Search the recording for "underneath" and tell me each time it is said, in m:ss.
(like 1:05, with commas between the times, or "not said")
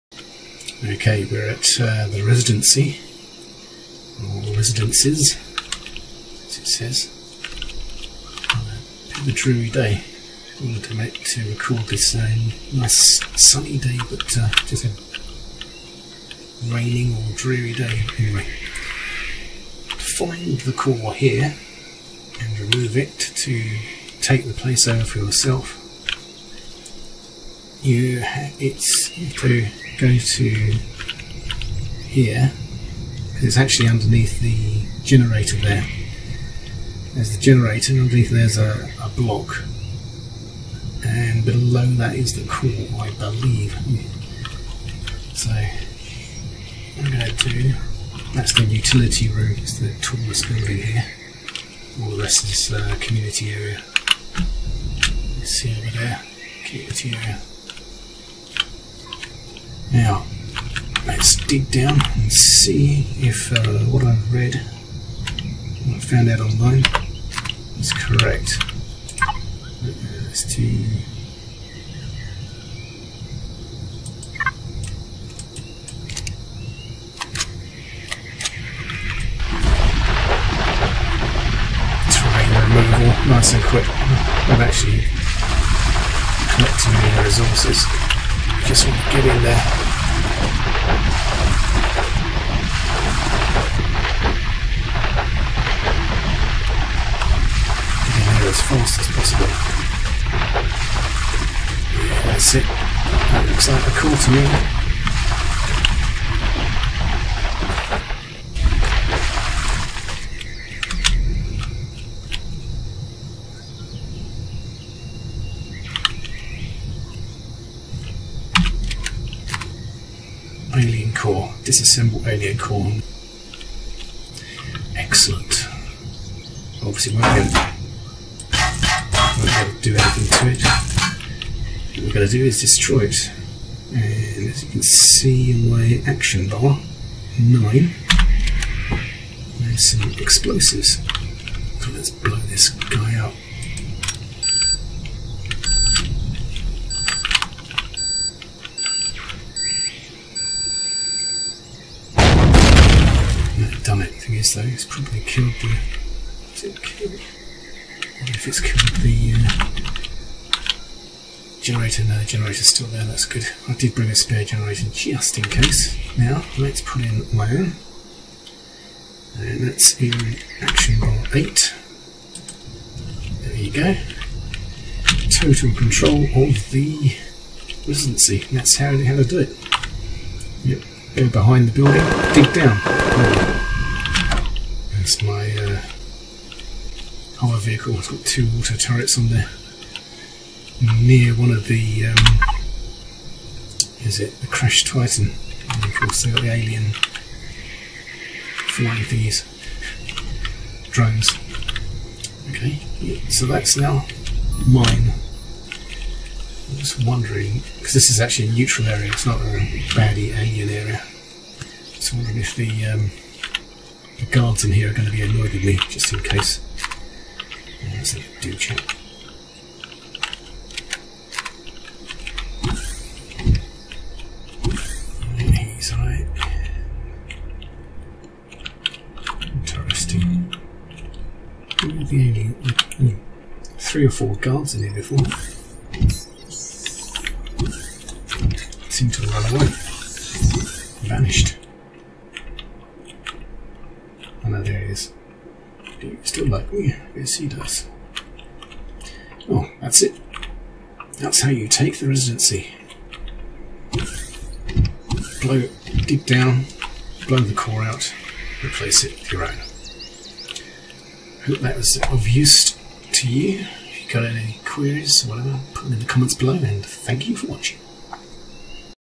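0:33, 0:38.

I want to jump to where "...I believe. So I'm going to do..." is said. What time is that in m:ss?
0:43.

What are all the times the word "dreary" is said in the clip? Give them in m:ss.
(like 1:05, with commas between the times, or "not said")
0:09, 0:17.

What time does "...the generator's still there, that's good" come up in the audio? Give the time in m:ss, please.
2:42.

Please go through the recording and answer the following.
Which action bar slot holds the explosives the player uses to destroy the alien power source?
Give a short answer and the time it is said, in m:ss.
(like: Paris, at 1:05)
9, at 2:17.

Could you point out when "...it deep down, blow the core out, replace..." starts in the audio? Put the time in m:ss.
4:15.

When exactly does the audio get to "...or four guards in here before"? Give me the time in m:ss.
3:54.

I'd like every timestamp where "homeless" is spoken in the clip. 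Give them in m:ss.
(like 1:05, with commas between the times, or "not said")
not said.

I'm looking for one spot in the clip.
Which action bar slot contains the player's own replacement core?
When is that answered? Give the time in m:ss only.
2:51.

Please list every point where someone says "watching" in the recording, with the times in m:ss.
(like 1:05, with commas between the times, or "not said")
4:27.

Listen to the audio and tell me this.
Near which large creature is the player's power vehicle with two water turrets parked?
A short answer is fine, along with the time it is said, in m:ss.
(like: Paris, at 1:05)
Crash Titan, at 3:14.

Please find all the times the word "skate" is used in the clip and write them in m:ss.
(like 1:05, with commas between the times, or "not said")
not said.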